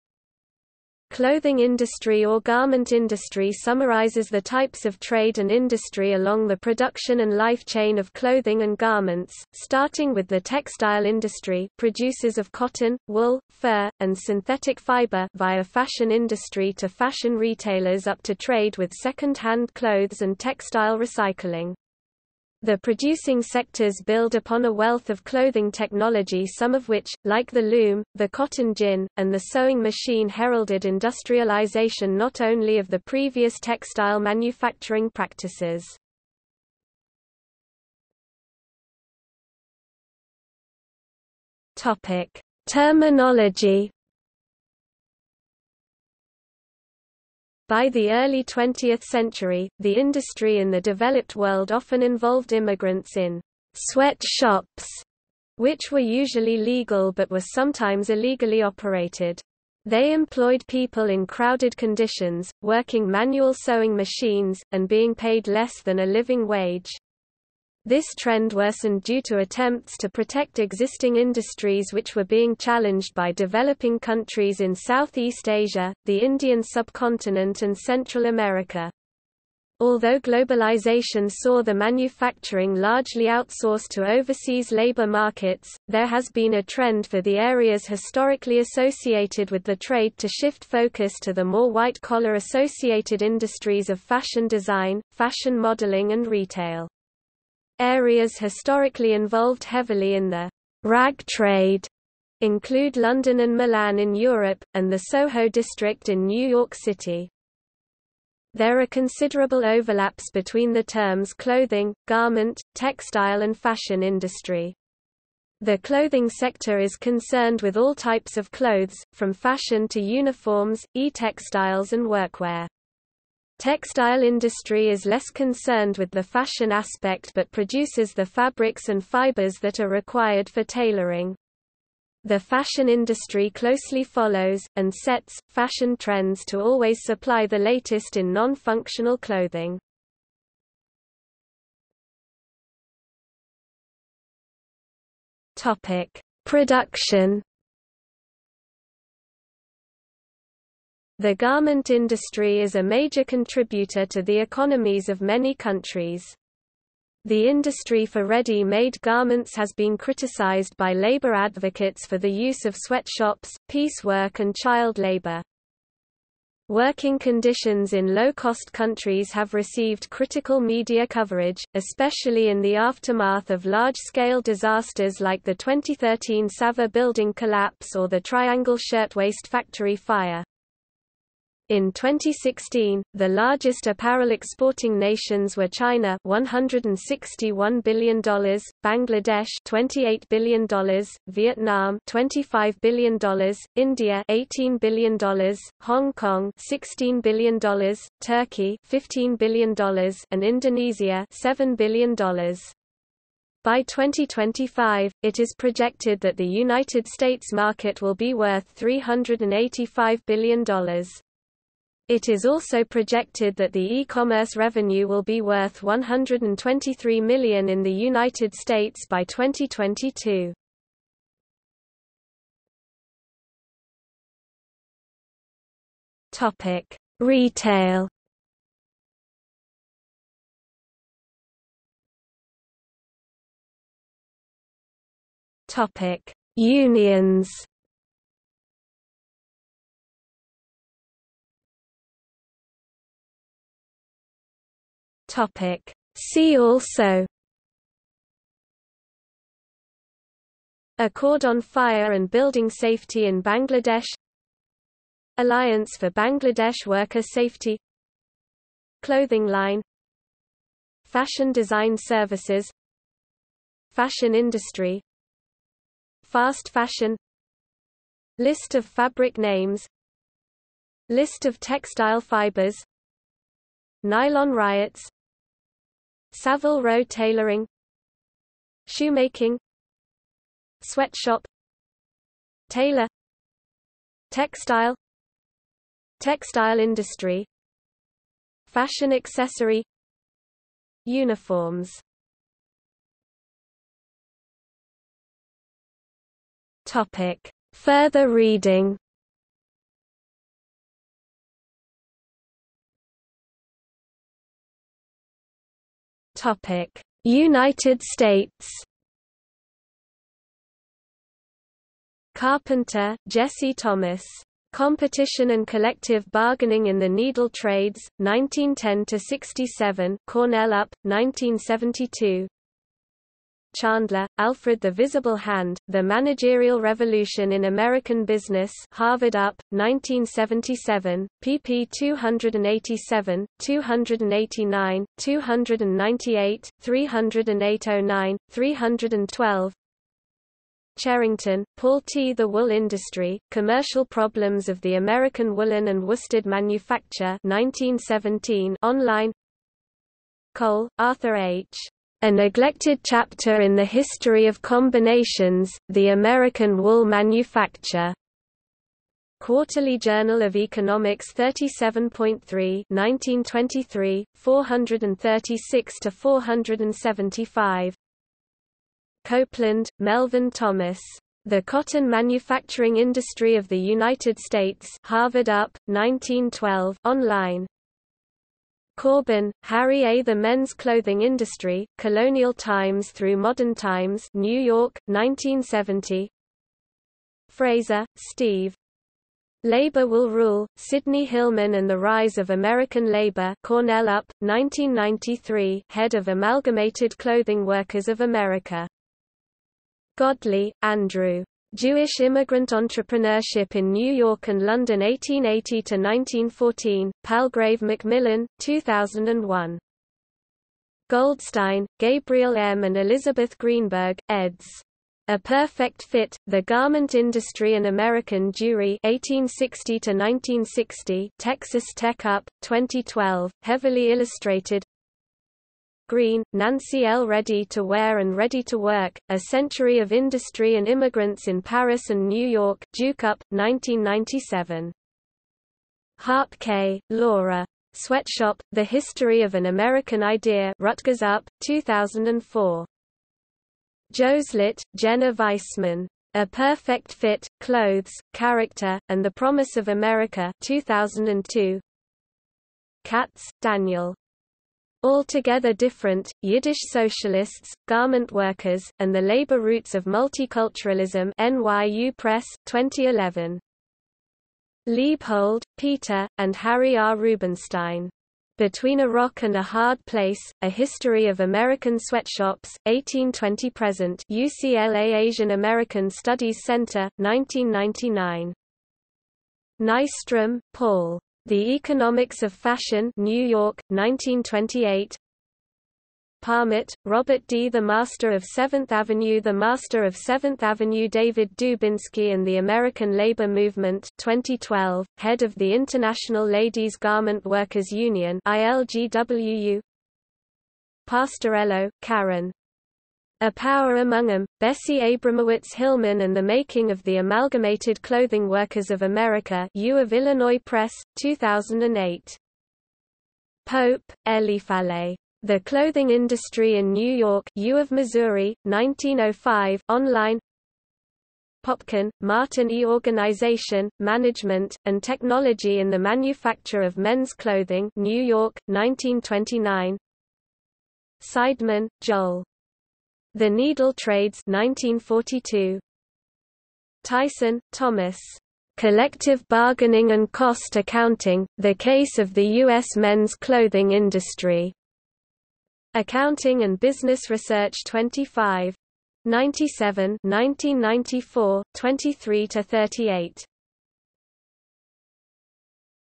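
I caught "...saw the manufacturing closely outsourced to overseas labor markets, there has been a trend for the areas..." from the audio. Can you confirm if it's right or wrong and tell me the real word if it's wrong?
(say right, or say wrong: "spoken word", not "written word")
wrong: "largely", not "closely".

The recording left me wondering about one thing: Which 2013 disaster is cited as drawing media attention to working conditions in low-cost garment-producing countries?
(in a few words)
Savar building collapse.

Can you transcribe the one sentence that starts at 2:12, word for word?
The fashion industry closely follows, and sets, fashion trends to always supply the latest in non-functional clothing.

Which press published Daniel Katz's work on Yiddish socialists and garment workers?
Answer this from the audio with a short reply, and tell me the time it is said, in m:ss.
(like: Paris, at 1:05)
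NYU Press, at 7:41.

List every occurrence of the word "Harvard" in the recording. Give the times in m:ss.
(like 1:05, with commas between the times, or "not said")
5:28, 6:15.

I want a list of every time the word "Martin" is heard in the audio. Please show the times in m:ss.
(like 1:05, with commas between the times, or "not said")
8:42.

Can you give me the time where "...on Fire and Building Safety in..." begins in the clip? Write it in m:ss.
4:11.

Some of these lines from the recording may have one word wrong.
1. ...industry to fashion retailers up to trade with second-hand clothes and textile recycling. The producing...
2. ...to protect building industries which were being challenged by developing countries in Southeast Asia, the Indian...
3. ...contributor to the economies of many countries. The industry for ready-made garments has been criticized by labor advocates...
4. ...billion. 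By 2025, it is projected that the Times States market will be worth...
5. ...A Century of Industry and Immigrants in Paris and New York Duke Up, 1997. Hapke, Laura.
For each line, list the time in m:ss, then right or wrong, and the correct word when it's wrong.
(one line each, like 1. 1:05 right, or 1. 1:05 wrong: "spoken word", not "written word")
1. 0:16 right
2. 1:09 wrong: "existing", not "building"
3. 2:33 right
4. 3:21 wrong: "United", not "Times"
5. 7:09 right.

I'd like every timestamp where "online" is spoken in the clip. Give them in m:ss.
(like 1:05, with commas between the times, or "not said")
5:48, 6:17, 8:39.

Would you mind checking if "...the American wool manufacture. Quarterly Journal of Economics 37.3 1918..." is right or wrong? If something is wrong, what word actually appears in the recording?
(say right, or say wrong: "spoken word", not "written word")
wrong: "1923", not "1918".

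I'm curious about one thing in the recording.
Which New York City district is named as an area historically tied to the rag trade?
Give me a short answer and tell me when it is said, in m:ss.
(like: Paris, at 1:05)
Soho, at 1:45.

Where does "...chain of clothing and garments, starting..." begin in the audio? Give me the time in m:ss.
0:07.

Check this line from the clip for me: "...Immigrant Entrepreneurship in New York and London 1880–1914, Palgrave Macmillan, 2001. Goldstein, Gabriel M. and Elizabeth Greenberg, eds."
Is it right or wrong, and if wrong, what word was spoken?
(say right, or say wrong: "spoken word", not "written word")
right.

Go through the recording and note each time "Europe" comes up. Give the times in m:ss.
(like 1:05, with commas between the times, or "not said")
1:44.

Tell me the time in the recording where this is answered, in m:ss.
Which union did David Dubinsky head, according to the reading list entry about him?
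8:15.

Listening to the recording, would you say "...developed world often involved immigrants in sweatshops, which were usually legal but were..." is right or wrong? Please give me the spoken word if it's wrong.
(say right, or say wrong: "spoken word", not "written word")
right.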